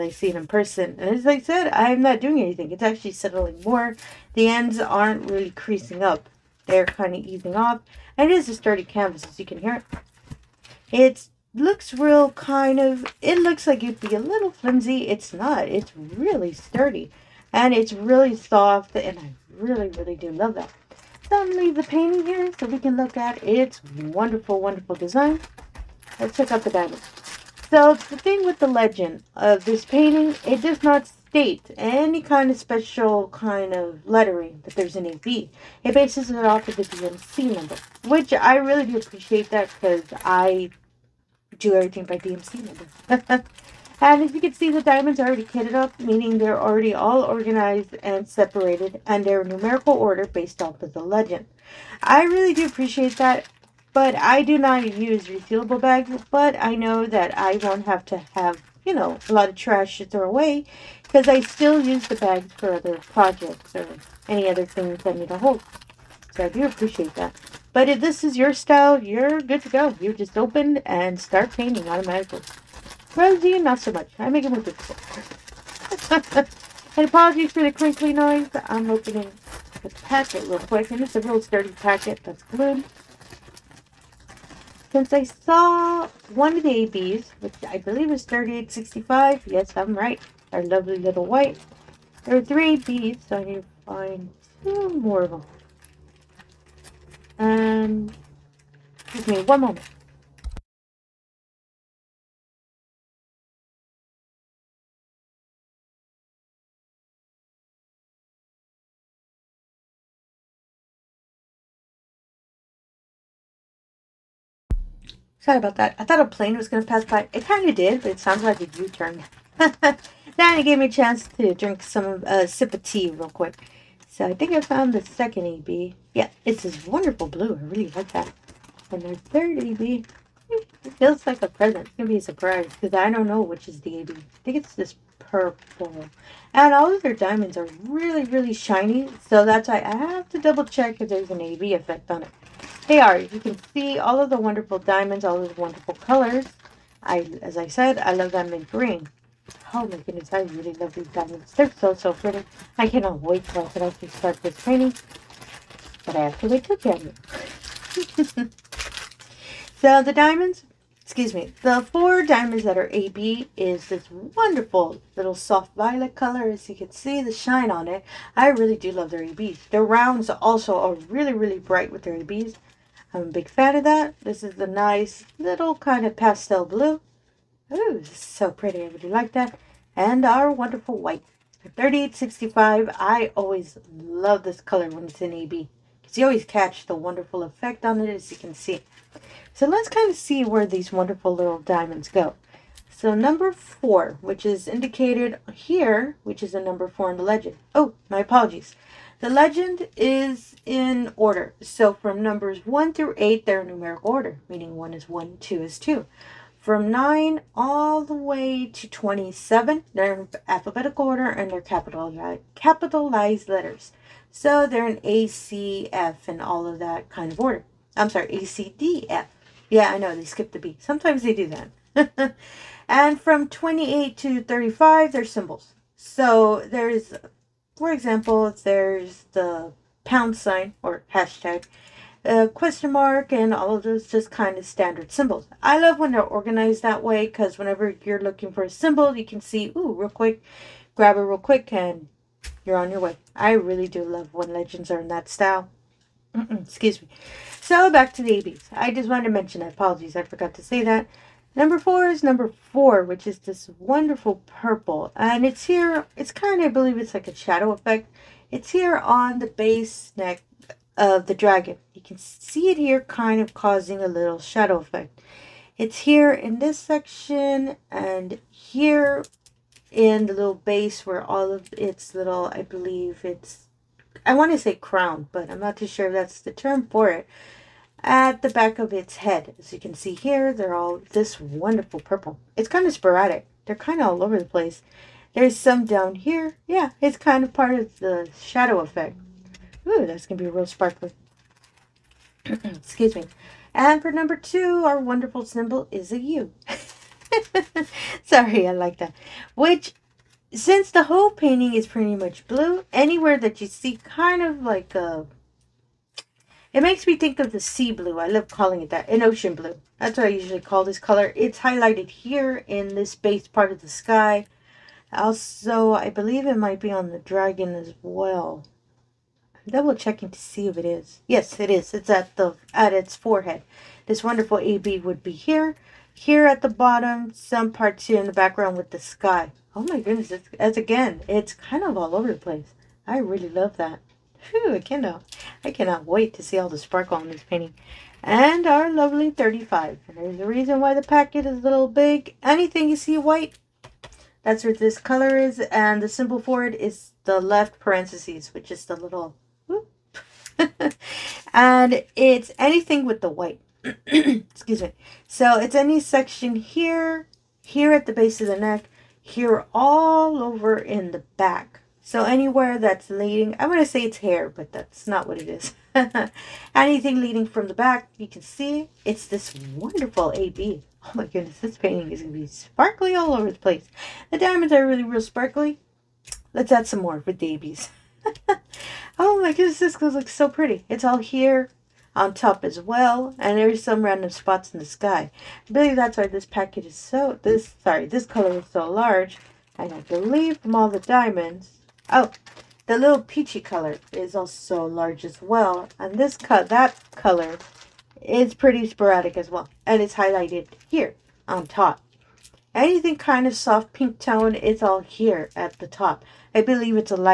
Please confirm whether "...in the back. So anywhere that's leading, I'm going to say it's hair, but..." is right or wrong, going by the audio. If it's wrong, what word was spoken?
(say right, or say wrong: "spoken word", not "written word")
right.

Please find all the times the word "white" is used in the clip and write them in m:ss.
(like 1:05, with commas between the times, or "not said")
1:31, 3:00, 5:43, 5:53.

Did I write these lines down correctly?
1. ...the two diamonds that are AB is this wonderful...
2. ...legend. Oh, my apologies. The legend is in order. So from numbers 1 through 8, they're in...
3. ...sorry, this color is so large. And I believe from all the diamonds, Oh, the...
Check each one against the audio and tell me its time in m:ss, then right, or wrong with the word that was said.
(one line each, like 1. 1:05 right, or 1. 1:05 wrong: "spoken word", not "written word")
1. 2:41 wrong: "four", not "two"
2. 3:17 right
3. 6:27 right.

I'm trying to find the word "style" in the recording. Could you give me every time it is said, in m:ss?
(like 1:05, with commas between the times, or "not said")
1:08, 4:05.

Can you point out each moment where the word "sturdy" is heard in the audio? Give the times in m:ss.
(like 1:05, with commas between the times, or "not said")
0:08, 0:16, 1:21.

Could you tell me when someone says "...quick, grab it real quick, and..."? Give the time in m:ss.
4:00.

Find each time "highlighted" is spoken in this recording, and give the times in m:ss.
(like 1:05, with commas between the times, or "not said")
5:11, 6:40.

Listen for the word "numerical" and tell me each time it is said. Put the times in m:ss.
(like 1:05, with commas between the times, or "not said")
0:49, 3:23.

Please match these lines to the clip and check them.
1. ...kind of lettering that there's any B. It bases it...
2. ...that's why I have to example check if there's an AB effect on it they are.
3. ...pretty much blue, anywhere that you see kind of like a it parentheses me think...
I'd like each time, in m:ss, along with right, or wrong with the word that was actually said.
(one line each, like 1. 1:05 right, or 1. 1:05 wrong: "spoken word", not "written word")
1. 0:33 right
2. 2:19 wrong: "double", not "example"
3. 5:01 wrong: "makes", not "parentheses".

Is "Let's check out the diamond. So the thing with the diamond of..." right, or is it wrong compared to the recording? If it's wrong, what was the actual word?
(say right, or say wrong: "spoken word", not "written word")
wrong: "legend", not "diamond".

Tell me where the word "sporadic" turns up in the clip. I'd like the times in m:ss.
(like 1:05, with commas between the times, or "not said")
4:42, 6:38.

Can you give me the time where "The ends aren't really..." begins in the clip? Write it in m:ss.
0:04.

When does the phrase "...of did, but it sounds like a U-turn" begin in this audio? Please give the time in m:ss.
1:57.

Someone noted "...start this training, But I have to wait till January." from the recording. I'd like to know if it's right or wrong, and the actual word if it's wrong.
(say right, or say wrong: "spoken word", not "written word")
right.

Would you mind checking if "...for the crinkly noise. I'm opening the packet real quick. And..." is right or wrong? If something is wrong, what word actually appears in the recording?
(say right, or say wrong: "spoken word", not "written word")
right.